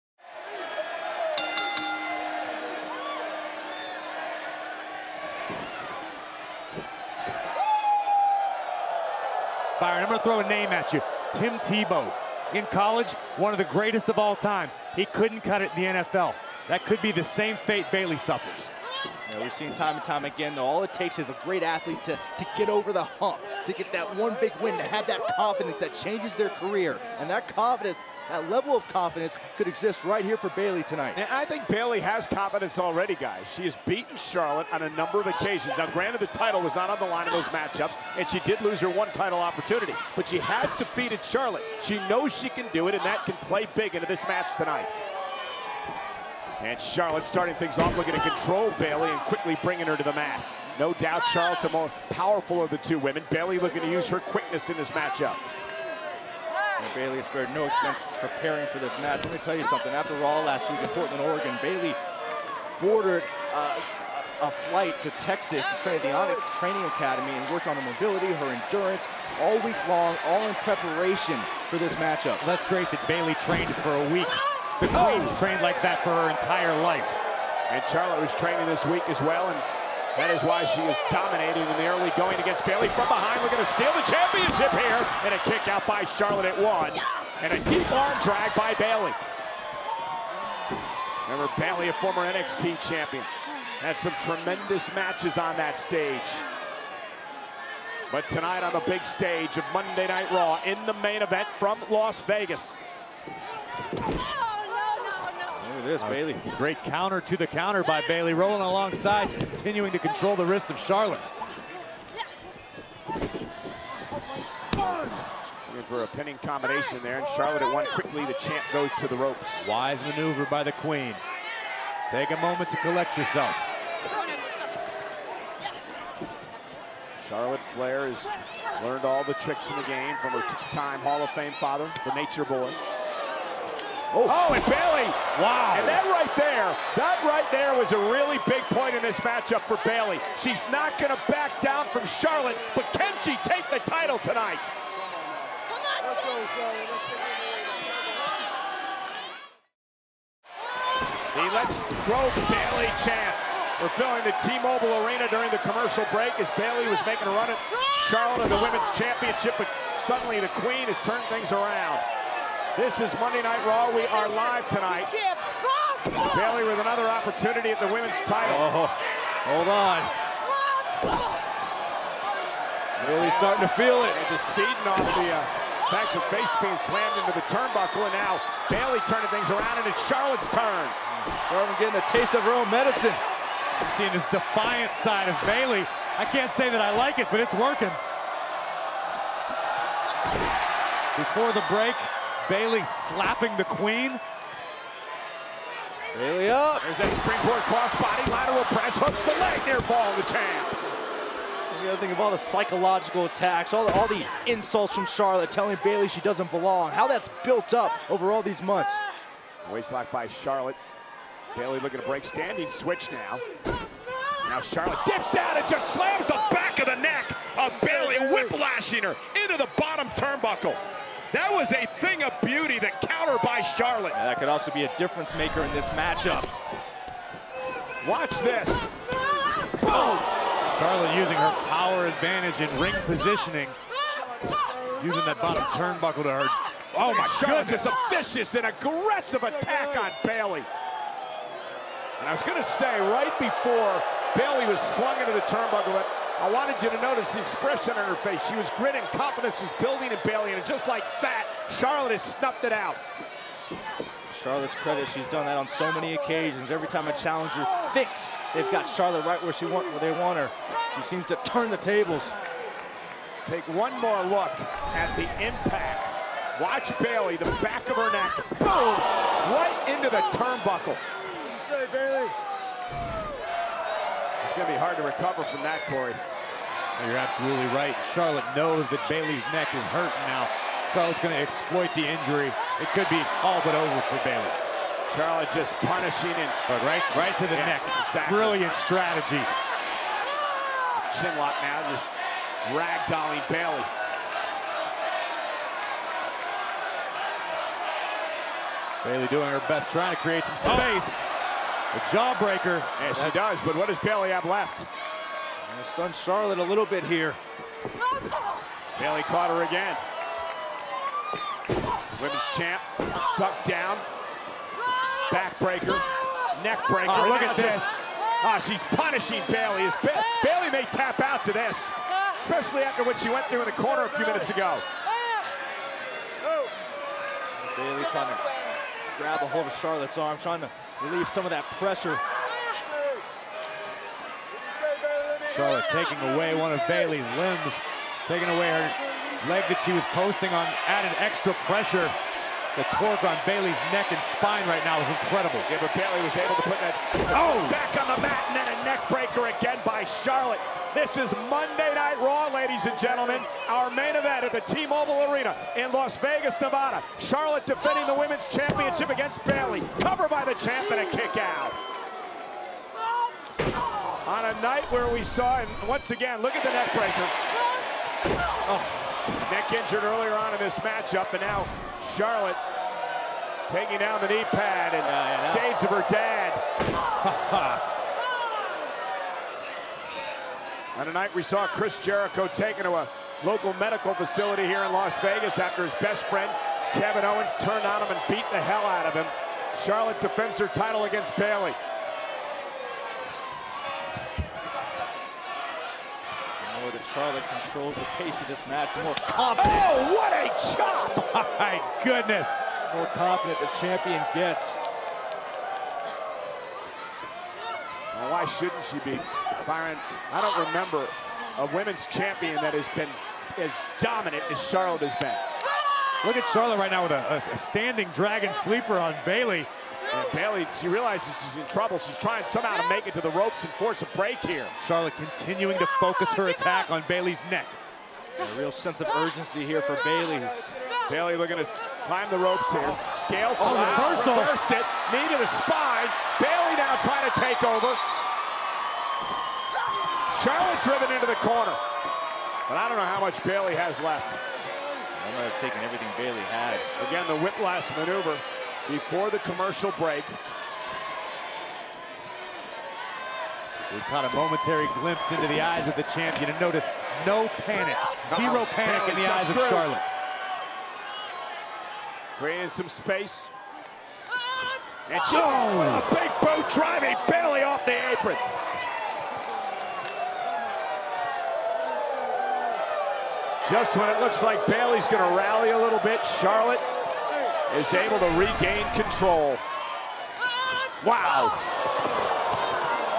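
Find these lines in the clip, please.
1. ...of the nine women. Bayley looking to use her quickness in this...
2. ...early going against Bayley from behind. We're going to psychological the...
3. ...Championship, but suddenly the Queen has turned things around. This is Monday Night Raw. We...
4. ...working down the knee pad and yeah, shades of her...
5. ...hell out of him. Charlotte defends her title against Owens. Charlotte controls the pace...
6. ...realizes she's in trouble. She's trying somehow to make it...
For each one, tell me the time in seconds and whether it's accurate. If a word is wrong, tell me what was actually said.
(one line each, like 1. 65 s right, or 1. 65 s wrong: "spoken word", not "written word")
1. 52 s wrong: "two", not "nine"
2. 81 s wrong: "steal", not "psychological"
3. 158 s right
4. 373 s wrong: "taking", not "working"
5. 388 s wrong: "Bayley", not "Owens"
6. 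420 s right.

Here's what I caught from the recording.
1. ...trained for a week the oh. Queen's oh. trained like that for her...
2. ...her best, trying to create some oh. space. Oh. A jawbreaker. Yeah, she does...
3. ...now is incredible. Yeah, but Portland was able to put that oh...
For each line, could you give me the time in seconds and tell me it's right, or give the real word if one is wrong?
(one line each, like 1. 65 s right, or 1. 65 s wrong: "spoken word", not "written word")
1. 73 s right
2. 299 s right
3. 344 s wrong: "Bayley", not "Portland".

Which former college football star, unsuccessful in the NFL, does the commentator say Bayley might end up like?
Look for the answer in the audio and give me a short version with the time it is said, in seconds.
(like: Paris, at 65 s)
Tim Tebow, at 11 s.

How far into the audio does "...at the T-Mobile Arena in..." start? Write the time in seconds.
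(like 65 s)
354 s.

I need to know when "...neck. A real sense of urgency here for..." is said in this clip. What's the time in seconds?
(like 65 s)
427 s.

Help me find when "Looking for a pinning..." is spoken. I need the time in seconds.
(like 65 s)
114 s.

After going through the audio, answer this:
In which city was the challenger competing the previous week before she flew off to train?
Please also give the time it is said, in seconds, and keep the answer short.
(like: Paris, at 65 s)
Portland, Oregon, at 60 s.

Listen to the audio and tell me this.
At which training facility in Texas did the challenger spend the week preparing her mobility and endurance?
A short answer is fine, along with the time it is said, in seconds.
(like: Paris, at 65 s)
Onyx Training Academy, at 66 s.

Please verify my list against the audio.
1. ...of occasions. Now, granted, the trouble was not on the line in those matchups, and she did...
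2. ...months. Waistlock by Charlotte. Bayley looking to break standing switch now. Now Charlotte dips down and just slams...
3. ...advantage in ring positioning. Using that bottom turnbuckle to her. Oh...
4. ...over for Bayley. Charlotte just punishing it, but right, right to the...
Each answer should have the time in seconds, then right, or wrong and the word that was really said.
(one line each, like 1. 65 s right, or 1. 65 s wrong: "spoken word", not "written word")
1. 35 s wrong: "title", not "trouble"
2. 208 s right
3. 232 s right
4. 283 s right.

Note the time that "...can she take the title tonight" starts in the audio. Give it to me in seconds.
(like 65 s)
142 s.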